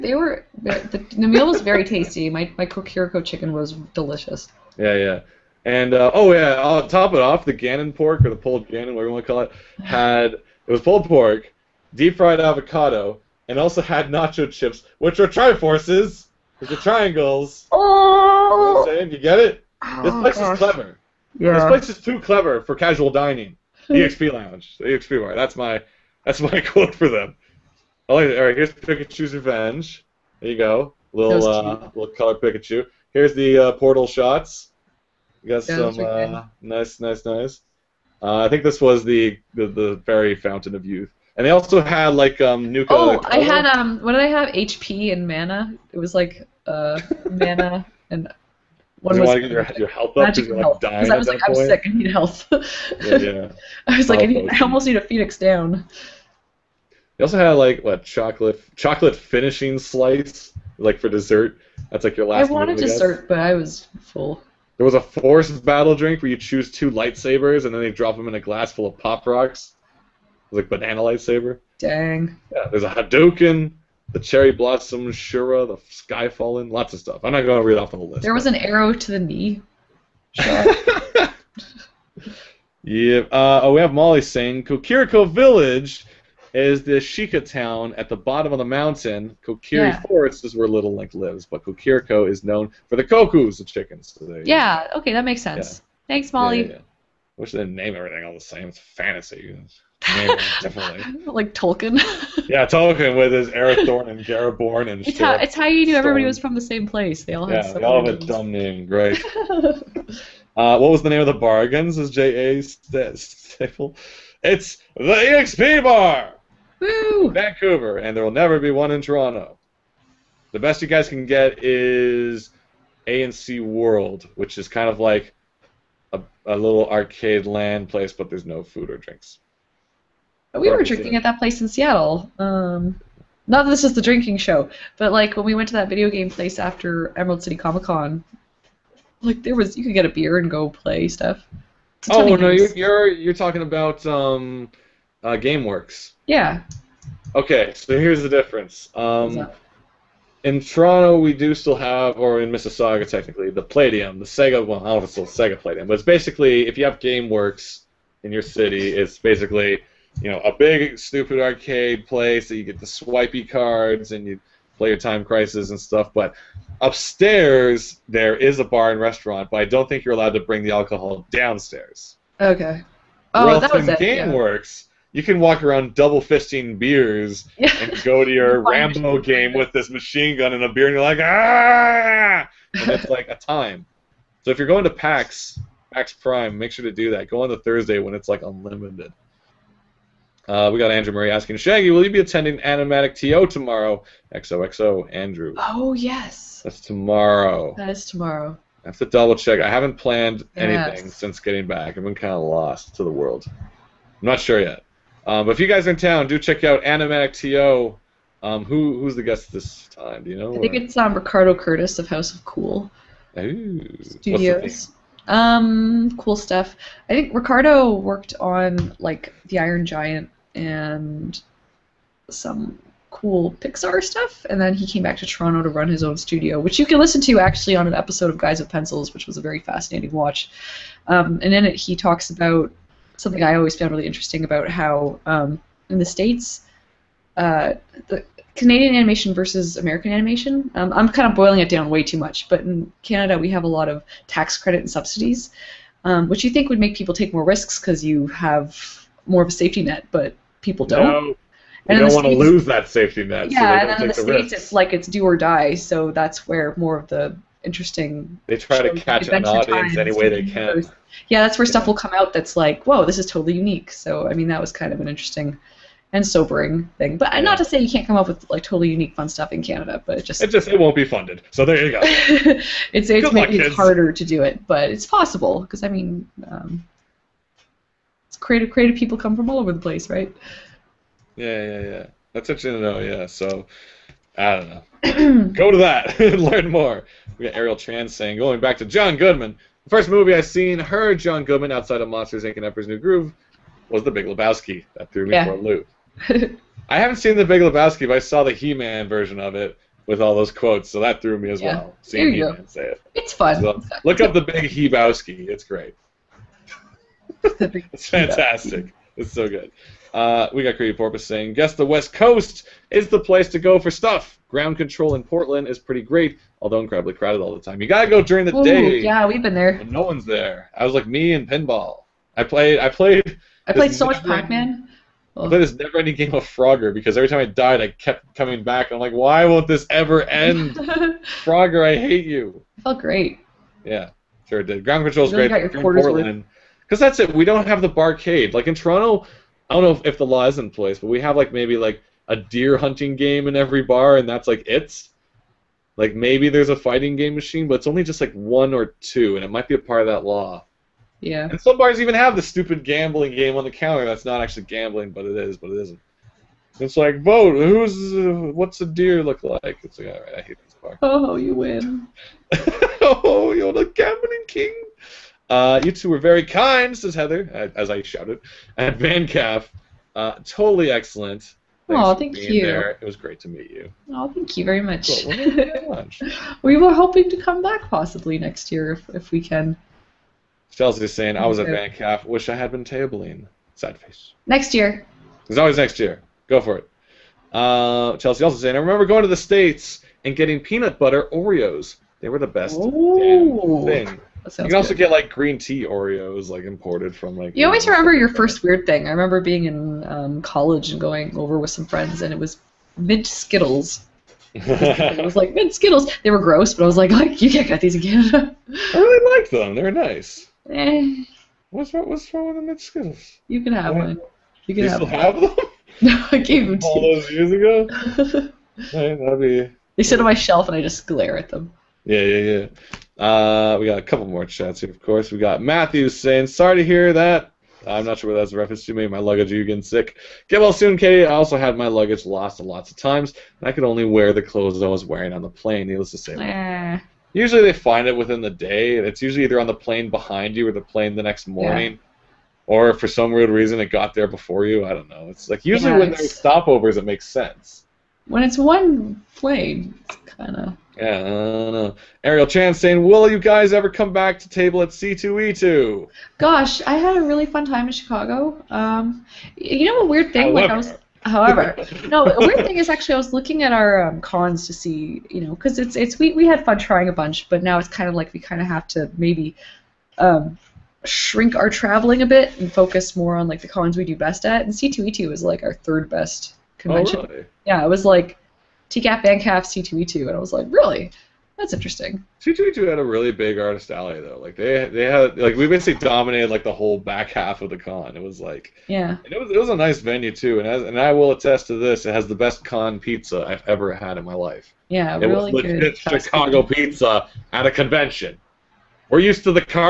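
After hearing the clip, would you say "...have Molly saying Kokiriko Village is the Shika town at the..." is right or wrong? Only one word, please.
right.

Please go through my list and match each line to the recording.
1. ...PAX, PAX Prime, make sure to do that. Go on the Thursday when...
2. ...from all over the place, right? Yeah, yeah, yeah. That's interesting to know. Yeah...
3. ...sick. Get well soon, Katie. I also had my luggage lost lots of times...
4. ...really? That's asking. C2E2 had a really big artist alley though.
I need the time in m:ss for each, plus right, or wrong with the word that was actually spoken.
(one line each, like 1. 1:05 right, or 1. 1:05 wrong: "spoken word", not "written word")
1. 3:04 right
2. 4:39 right
3. 7:09 right
4. 8:00 wrong: "interesting", not "asking".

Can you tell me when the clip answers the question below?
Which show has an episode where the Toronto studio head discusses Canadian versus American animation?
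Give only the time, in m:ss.
3:48.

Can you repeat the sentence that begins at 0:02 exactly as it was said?
My my kokiriko chicken was delicious.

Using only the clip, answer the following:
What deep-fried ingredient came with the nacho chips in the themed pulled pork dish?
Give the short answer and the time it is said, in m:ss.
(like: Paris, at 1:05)
Avocado, at 0:11.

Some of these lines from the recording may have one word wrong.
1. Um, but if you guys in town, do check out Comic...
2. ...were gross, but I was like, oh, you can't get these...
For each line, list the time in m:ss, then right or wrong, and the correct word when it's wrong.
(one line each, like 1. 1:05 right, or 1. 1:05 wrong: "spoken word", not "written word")
1. 3:25 wrong: "Animatic", not "Comic"
2. 6:46 right.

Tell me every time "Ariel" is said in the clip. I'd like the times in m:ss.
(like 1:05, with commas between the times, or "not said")
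4:47, 7:32.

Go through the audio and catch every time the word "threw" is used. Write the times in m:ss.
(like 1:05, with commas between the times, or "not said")
4:55, 5:01.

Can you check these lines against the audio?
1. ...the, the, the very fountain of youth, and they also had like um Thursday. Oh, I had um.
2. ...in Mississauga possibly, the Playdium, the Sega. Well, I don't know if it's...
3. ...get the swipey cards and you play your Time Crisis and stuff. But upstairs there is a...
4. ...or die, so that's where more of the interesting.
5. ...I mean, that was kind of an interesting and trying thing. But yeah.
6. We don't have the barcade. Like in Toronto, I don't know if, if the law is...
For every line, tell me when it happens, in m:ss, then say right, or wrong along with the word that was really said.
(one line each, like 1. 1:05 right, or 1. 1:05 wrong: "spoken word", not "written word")
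1. 0:39 wrong: "Nuka", not "Thursday"
2. 2:32 wrong: "technically", not "possibly"
3. 2:42 right
4. 4:15 right
5. 4:24 wrong: "sobering", not "trying"
6. 5:37 right.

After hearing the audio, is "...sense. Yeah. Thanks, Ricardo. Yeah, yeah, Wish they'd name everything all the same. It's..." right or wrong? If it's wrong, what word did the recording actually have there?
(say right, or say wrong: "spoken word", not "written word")
wrong: "Molly", not "Ricardo".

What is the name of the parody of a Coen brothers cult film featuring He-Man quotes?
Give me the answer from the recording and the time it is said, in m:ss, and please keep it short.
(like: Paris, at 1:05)
The Big Hebowski, at 5:04.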